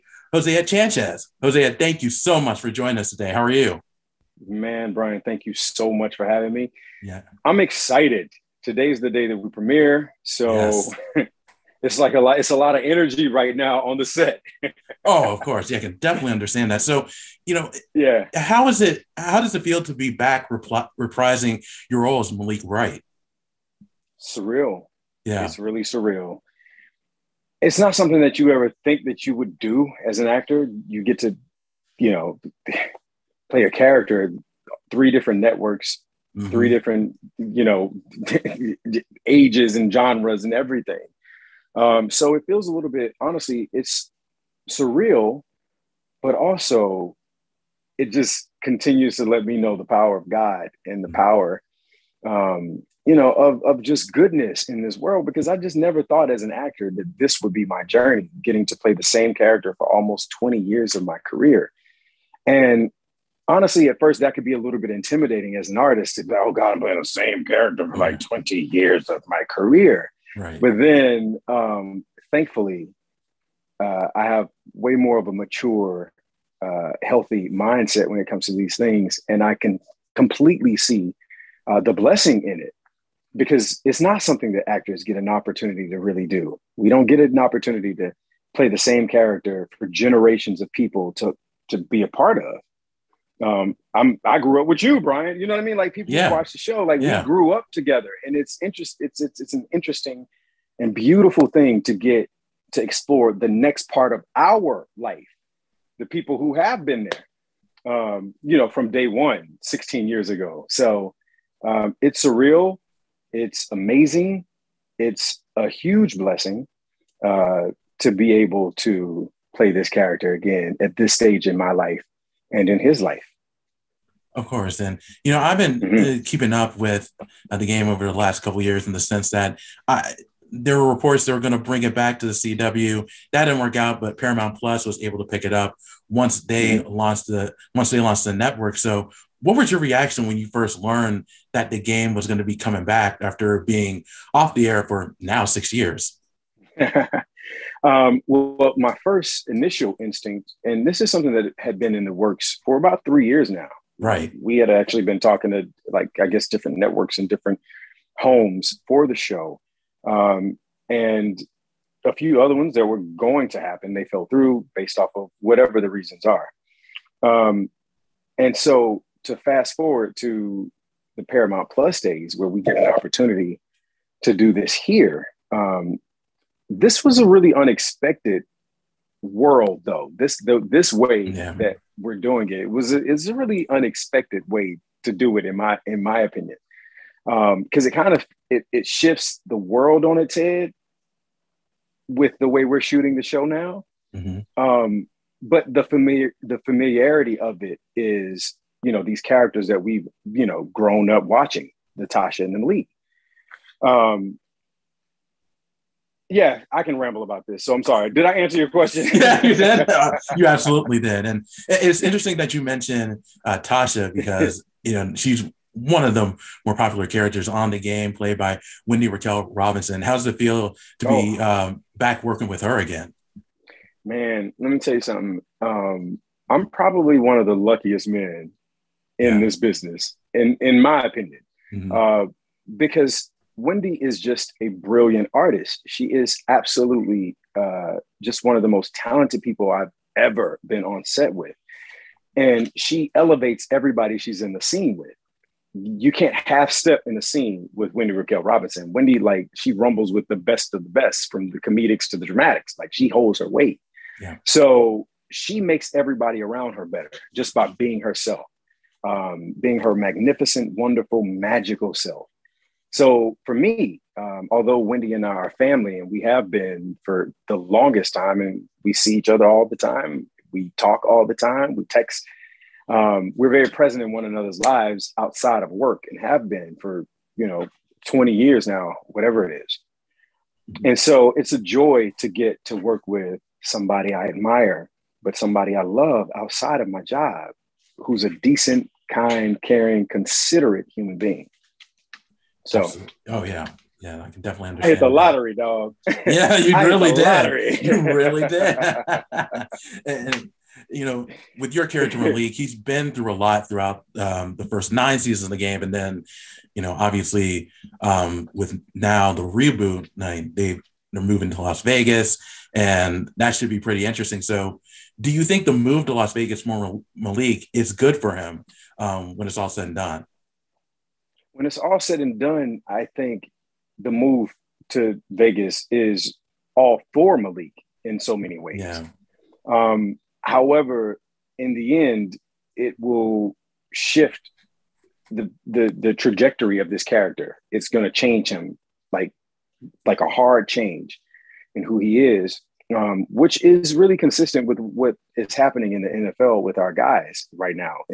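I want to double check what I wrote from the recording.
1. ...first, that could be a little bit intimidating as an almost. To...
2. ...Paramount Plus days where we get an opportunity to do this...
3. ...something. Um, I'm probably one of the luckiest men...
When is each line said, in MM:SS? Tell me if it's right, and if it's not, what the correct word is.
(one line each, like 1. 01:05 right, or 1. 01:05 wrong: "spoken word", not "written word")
1. 01:03 wrong: "artist", not "almost"
2. 02:51 right
3. 03:45 right.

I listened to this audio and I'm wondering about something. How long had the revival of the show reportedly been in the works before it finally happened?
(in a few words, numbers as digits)
3 years.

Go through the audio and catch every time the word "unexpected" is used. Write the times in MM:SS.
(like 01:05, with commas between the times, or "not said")
02:57, 03:03.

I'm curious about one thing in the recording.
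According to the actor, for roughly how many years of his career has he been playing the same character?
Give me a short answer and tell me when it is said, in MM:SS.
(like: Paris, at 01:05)
20 years, at 00:59.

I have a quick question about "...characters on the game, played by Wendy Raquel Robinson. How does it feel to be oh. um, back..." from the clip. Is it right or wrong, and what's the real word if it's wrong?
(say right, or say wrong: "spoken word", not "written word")
right.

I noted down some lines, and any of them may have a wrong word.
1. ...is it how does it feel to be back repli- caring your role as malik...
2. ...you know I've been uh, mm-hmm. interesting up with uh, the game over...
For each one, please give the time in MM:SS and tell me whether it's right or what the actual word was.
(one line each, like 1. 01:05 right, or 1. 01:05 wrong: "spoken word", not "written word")
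1. 00:18 wrong: "reprising", not "caring"
2. 02:05 wrong: "keeping", not "interesting".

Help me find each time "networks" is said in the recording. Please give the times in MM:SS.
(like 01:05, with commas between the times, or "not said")
00:35, 02:18, 02:36.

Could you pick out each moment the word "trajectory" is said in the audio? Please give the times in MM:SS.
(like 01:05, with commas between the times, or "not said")
05:36.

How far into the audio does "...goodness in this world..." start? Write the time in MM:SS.
00:54.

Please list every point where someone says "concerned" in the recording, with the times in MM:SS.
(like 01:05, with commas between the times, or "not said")
not said.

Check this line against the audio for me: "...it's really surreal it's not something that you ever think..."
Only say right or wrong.
right.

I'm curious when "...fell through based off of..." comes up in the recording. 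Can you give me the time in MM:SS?
02:44.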